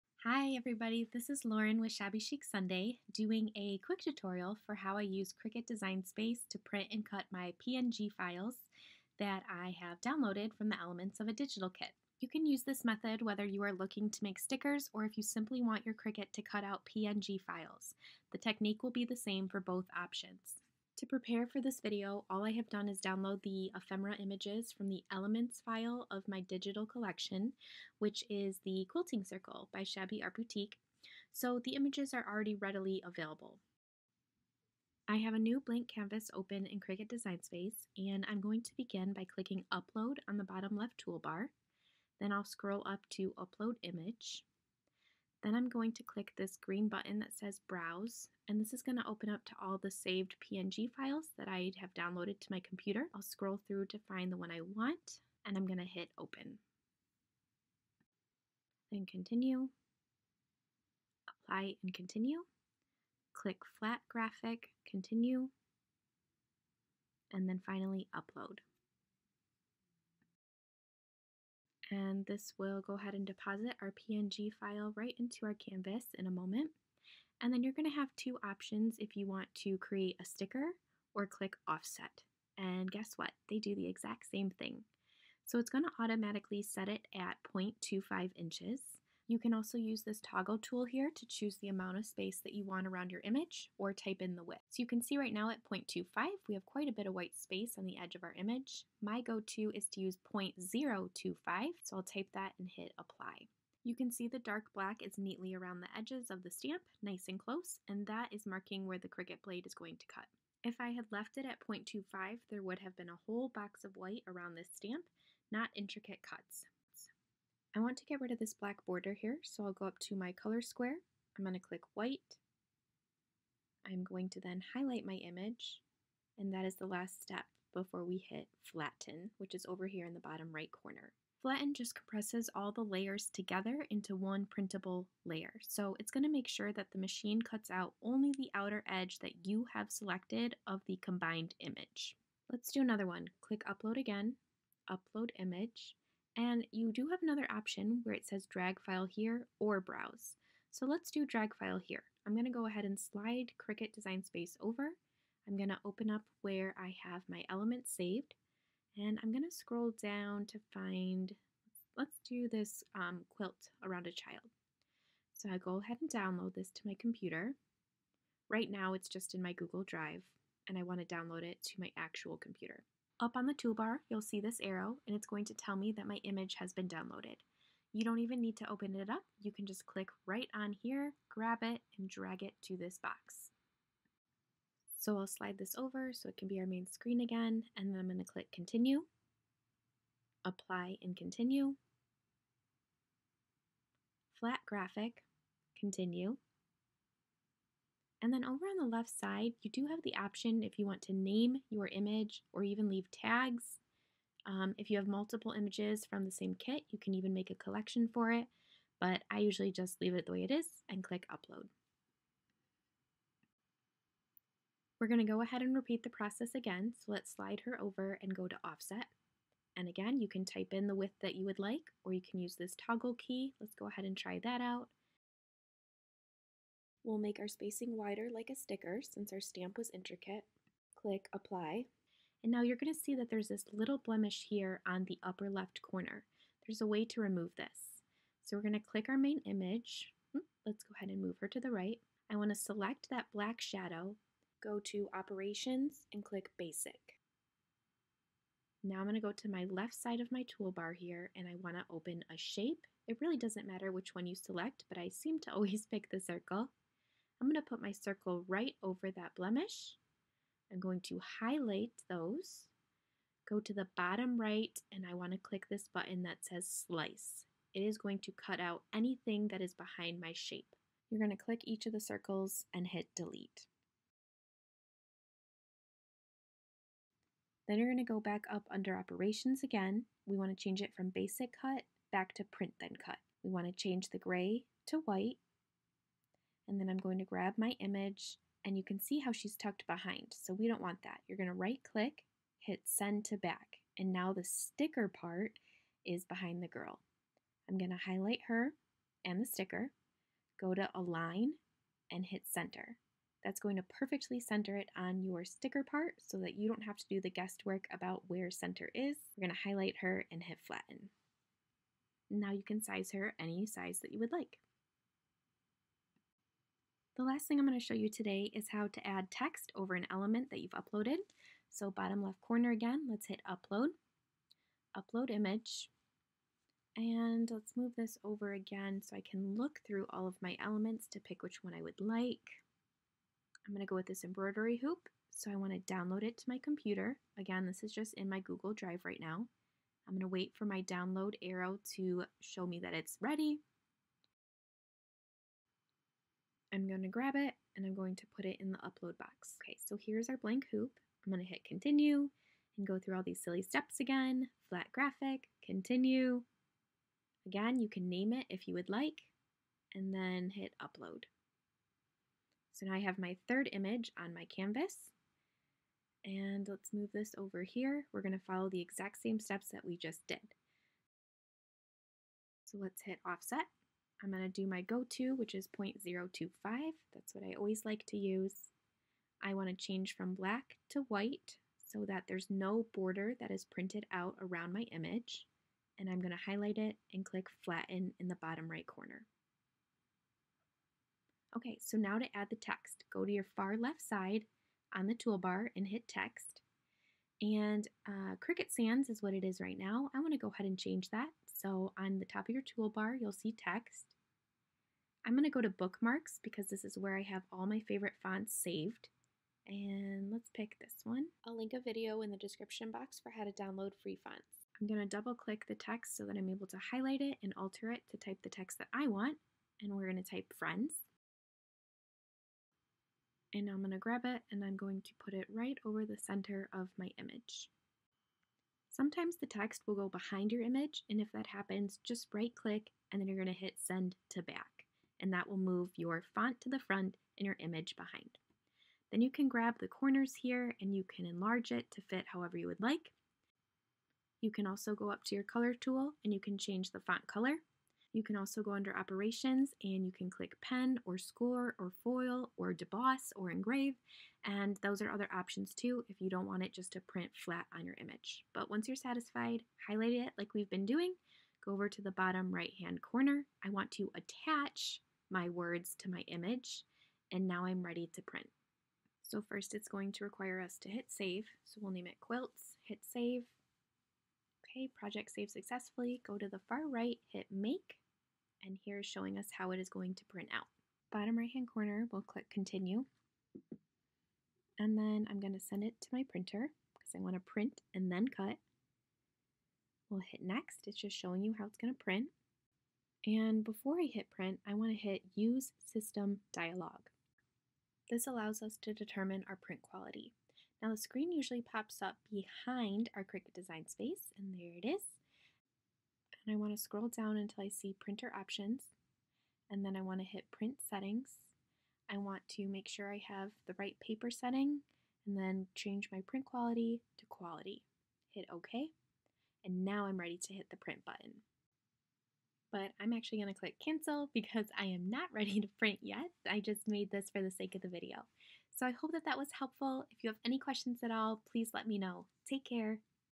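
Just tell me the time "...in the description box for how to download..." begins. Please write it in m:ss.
6:52.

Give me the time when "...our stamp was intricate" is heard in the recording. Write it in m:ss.
3:49.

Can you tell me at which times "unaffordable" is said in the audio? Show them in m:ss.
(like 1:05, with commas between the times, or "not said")
not said.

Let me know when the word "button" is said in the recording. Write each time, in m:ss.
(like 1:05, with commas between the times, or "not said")
0:46, 4:25, 8:41.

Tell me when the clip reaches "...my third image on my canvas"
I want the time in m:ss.
6:03.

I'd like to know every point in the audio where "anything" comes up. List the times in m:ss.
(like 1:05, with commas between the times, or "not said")
4:28.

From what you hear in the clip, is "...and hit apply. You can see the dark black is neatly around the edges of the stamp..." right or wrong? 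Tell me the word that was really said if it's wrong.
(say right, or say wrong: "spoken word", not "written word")
right.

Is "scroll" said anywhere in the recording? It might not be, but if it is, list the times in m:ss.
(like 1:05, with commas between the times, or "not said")
0:42, 0:53, 2:39, 8:26.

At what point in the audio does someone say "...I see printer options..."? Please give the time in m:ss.
8:27.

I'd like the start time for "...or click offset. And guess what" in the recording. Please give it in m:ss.
1:21.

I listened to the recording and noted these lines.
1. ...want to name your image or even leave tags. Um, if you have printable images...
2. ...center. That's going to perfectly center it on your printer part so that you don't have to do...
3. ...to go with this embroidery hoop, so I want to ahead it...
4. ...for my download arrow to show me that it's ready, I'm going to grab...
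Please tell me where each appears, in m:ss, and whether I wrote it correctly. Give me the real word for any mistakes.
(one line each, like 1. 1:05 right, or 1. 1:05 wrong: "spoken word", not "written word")
1. 3:20 wrong: "multiple", not "printable"
2. 5:02 wrong: "sticker", not "printer"
3. 5:33 wrong: "download", not "ahead"
4. 5:40 right.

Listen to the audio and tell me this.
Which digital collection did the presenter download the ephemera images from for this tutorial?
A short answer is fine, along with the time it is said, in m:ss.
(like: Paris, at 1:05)
Quilting Circle, at 0:28.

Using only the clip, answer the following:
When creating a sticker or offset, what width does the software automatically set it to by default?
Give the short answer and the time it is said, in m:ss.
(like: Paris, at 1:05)
0.25 inches, at 1:27.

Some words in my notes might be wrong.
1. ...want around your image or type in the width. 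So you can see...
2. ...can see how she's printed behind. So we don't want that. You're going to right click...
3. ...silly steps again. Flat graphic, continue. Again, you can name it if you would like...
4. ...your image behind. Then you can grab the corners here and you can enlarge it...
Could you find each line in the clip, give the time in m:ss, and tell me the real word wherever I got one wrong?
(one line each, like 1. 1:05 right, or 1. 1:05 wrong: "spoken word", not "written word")
1. 1:32 right
2. 4:48 wrong: "tucked", not "printed"
3. 5:53 right
4. 7:17 right.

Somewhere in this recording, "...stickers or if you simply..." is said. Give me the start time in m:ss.
0:14.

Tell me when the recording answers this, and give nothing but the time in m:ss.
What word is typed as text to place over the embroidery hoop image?
7:00.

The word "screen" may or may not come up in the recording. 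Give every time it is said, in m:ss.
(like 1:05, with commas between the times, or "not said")
3:06, 8:20.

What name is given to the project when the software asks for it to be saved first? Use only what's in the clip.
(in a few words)
quilts.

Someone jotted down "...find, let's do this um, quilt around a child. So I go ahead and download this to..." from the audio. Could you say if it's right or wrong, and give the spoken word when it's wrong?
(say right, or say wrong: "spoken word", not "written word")
right.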